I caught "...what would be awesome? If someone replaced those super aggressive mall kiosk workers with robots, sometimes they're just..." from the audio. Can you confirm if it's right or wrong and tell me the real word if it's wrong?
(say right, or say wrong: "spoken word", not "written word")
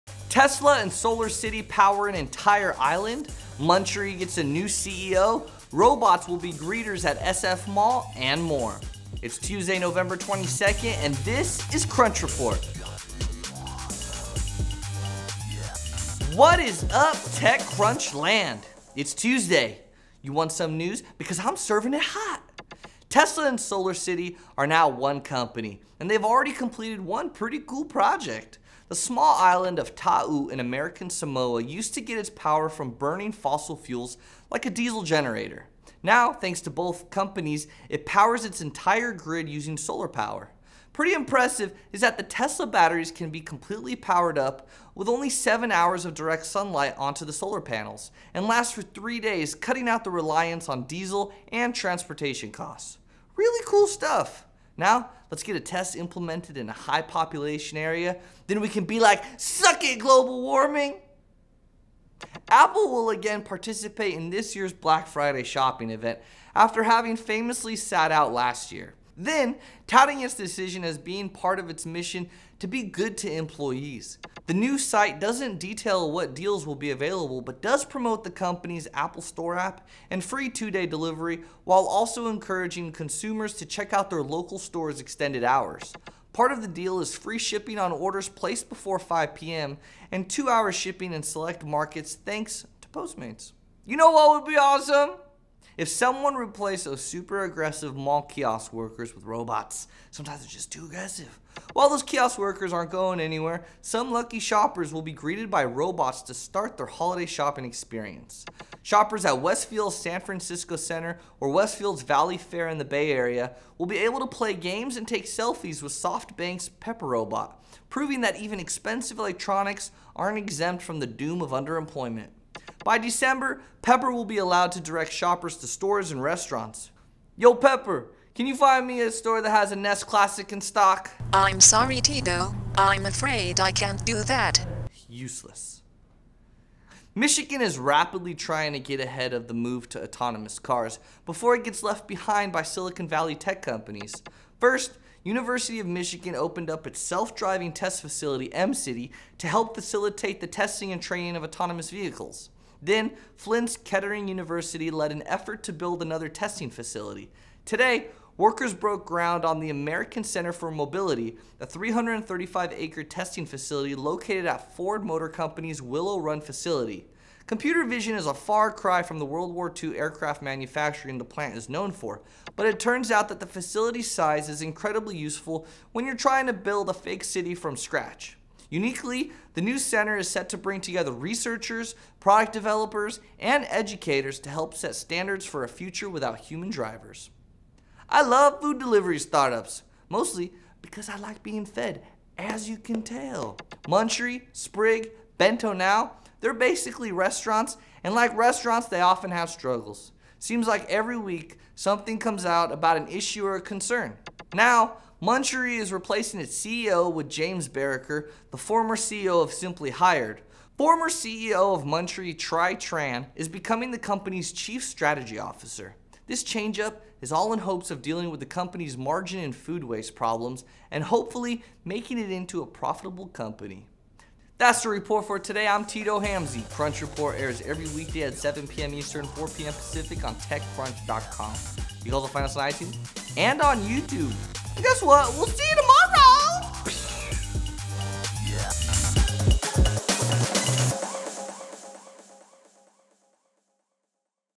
right.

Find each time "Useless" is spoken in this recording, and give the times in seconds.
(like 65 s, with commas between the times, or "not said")
135 s.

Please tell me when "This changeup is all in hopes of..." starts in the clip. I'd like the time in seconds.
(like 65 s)
216 s.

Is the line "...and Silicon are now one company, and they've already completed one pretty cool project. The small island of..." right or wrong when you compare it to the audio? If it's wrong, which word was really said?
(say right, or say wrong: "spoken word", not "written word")
wrong: "SolarCity", not "Silicon".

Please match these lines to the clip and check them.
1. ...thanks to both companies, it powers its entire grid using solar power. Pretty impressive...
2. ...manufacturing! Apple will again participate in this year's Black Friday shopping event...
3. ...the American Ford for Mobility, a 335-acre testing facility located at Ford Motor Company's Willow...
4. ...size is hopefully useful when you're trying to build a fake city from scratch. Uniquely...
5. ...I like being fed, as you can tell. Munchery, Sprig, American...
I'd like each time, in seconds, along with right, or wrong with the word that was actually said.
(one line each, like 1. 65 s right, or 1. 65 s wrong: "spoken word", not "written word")
1. 36 s right
2. 60 s wrong: "warming", not "manufacturing"
3. 159 s wrong: "Center", not "Ford"
4. 174 s wrong: "incredibly", not "hopefully"
5. 191 s wrong: "Bento", not "American".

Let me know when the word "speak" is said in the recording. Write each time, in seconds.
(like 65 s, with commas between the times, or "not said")
not said.